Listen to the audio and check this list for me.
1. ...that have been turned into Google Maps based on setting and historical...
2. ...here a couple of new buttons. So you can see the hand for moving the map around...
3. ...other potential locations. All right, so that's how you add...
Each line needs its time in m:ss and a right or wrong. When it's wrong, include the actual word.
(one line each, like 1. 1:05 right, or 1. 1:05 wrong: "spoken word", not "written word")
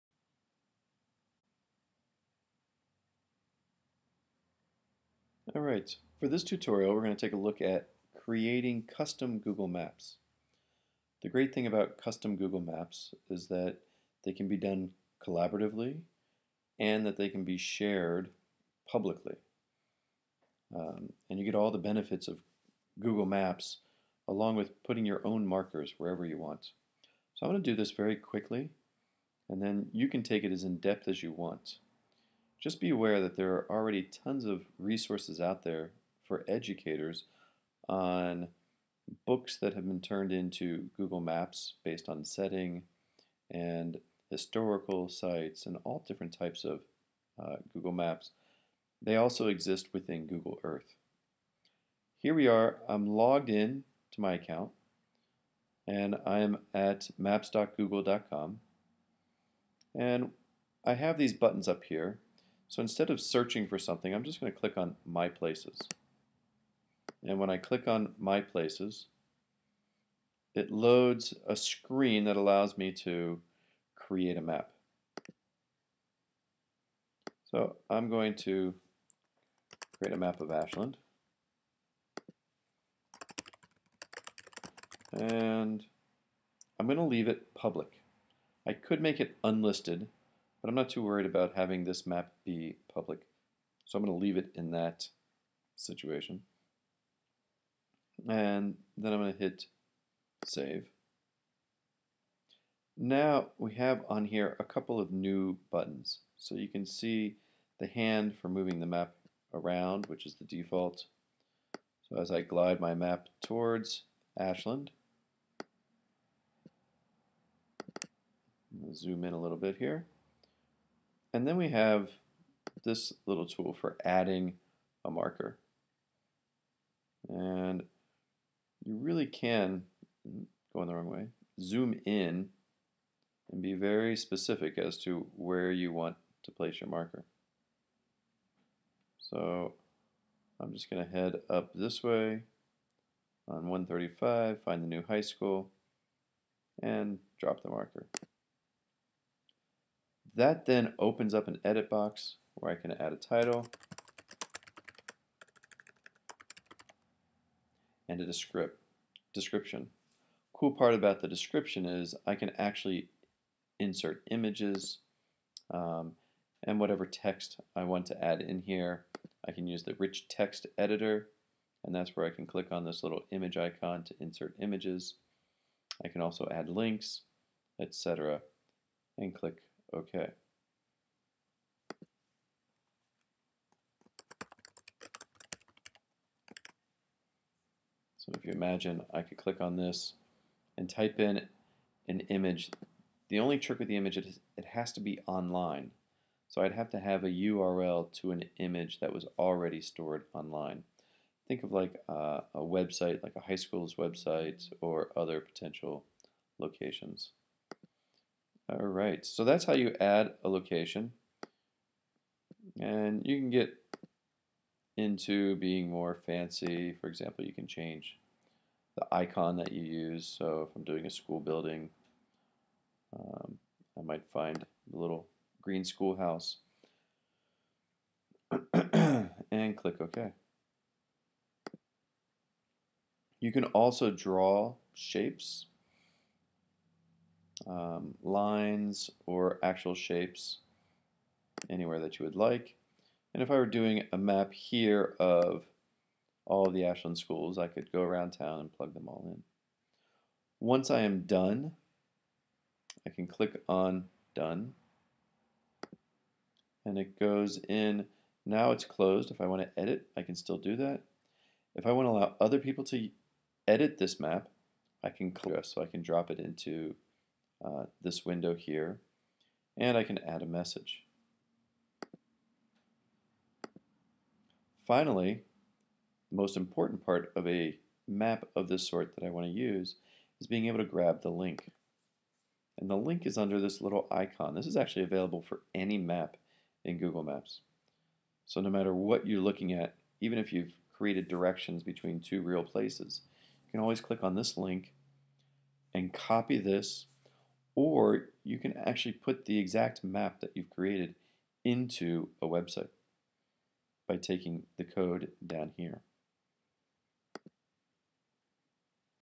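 1. 0:39 right
2. 1:44 right
3. 3:25 right.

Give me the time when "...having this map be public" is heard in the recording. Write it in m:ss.
1:31.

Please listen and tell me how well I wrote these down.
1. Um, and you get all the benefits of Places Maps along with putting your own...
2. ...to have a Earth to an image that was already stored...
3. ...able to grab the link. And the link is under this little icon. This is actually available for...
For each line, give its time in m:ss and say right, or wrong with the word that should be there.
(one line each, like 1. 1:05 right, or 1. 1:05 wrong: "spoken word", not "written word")
1. 0:20 wrong: "Google", not "Places"
2. 3:16 wrong: "URL", not "Earth"
3. 4:40 right.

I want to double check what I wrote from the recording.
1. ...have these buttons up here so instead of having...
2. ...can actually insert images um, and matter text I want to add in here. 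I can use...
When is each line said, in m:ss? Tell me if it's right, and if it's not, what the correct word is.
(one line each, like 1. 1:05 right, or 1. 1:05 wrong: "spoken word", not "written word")
1. 1:00 wrong: "searching", not "having"
2. 2:42 wrong: "whatever", not "matter".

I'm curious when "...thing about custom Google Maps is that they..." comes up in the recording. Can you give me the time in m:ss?
0:11.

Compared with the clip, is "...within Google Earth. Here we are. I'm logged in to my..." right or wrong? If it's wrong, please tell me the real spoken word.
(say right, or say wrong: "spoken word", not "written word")
right.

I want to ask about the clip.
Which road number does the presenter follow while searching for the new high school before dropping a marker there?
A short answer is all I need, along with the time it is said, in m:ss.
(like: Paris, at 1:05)
135, at 2:23.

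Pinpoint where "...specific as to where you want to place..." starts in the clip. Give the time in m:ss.
2:14.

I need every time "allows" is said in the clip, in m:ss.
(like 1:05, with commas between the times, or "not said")
1:12, 4:22.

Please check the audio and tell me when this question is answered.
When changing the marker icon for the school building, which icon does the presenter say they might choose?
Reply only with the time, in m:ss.
3:44.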